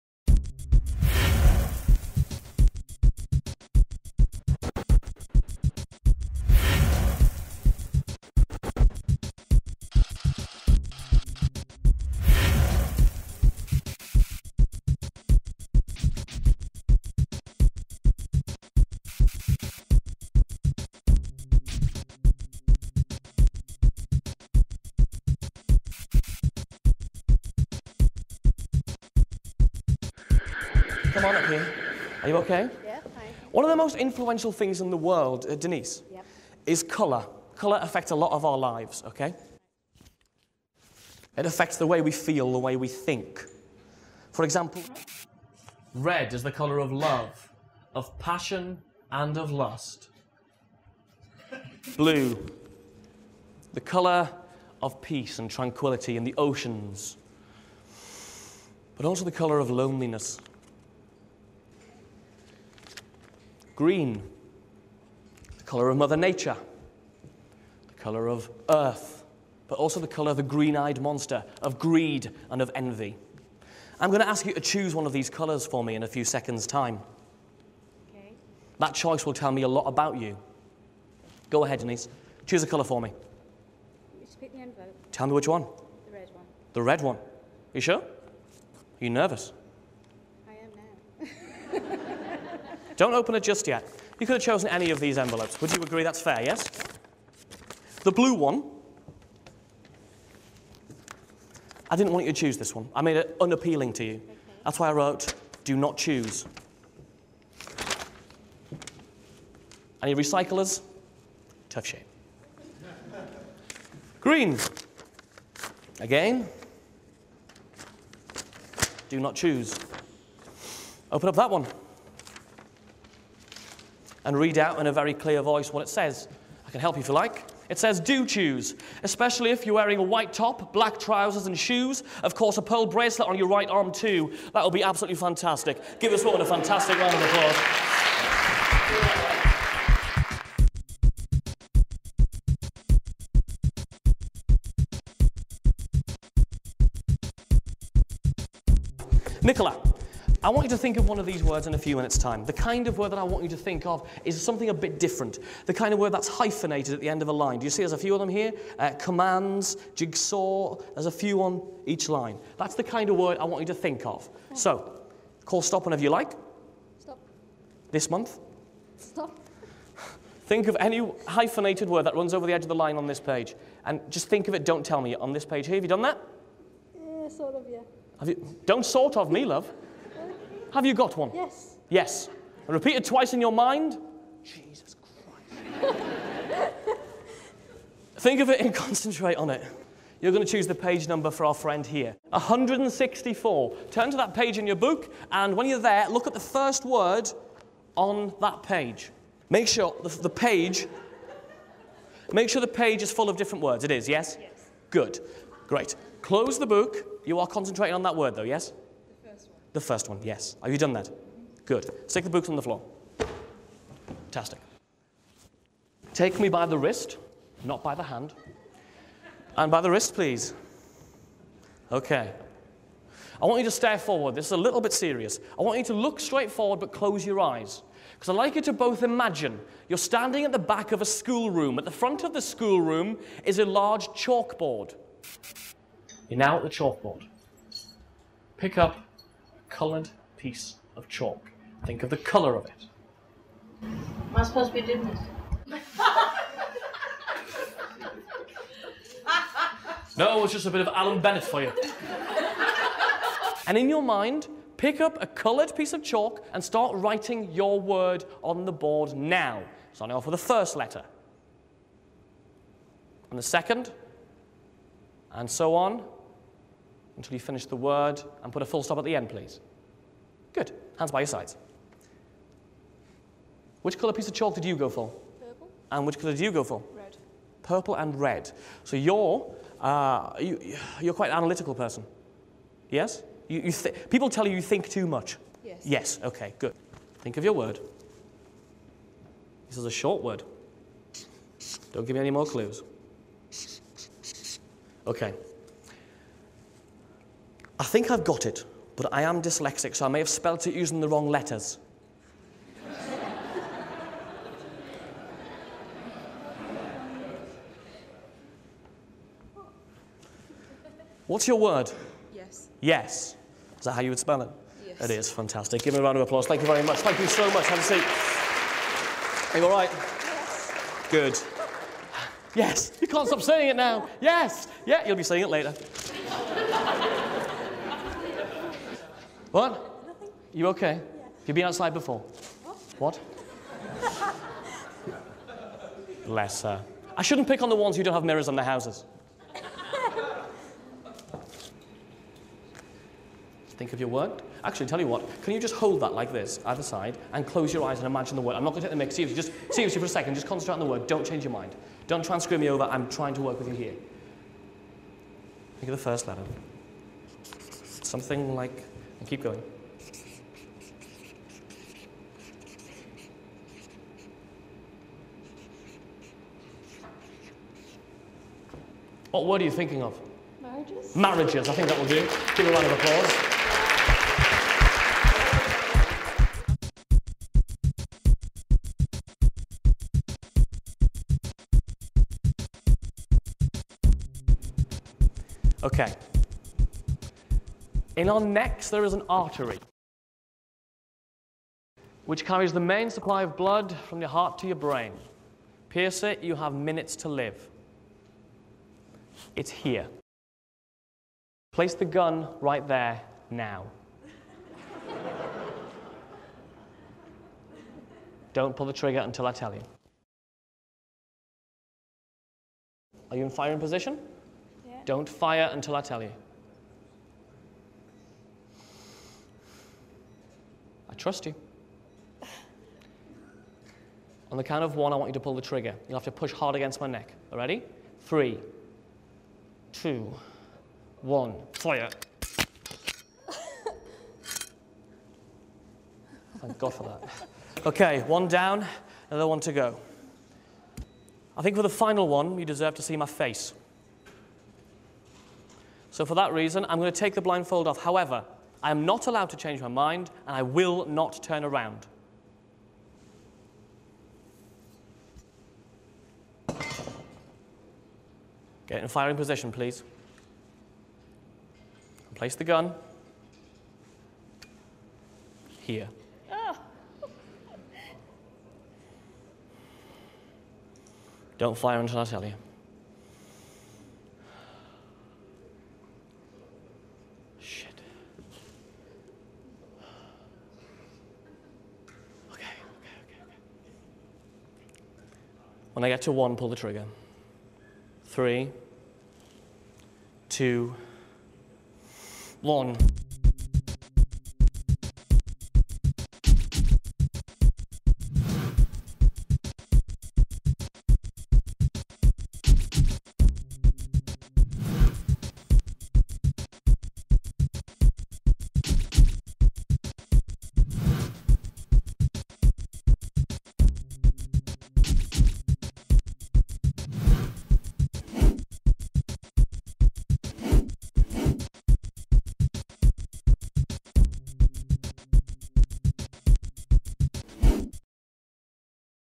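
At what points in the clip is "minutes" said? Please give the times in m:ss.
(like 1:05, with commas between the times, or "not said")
2:31, 6:36.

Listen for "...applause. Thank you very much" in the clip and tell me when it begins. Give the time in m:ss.
5:16.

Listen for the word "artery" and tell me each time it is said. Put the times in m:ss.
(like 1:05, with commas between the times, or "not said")
6:29.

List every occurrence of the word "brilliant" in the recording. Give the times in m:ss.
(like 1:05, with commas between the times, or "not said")
not said.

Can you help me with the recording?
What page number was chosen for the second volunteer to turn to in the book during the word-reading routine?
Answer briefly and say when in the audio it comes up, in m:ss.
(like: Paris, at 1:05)
164, at 3:12.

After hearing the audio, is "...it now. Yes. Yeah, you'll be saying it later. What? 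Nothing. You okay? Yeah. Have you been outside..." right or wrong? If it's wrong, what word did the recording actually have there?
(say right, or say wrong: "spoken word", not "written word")
right.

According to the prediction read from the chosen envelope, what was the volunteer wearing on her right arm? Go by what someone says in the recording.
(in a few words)
Pearl bracelet.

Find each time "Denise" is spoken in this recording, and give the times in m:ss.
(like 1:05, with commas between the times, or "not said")
0:35, 1:21.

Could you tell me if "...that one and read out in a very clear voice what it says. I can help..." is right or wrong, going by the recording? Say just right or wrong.
right.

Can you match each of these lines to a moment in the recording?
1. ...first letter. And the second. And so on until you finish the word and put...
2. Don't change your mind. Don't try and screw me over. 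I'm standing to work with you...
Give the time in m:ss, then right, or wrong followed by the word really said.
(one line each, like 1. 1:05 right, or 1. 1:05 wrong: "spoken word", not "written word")
1. 4:20 right
2. 5:51 wrong: "trying", not "standing".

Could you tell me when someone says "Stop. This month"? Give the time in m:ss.
2:46.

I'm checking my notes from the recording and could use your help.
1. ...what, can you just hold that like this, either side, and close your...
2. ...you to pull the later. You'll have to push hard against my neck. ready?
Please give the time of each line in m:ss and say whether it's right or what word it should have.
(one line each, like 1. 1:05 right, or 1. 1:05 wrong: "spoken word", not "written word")
1. 5:45 right
2. 7:05 wrong: "trigger", not "later".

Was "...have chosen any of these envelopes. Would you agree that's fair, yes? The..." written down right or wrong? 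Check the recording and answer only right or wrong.
right.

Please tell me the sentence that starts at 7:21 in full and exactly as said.
I think for the final one, you deserve to see my face.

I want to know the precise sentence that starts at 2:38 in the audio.
Uh, commands, jigsaw, there's a few on each line.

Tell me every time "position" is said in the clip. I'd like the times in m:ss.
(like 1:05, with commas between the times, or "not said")
6:53, 7:39.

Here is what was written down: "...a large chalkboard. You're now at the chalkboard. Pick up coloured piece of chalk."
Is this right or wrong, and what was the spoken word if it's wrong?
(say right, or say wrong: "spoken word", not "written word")
right.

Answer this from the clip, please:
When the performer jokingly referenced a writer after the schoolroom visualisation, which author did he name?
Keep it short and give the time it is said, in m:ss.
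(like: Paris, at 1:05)
Alan Bennett, at 4:10.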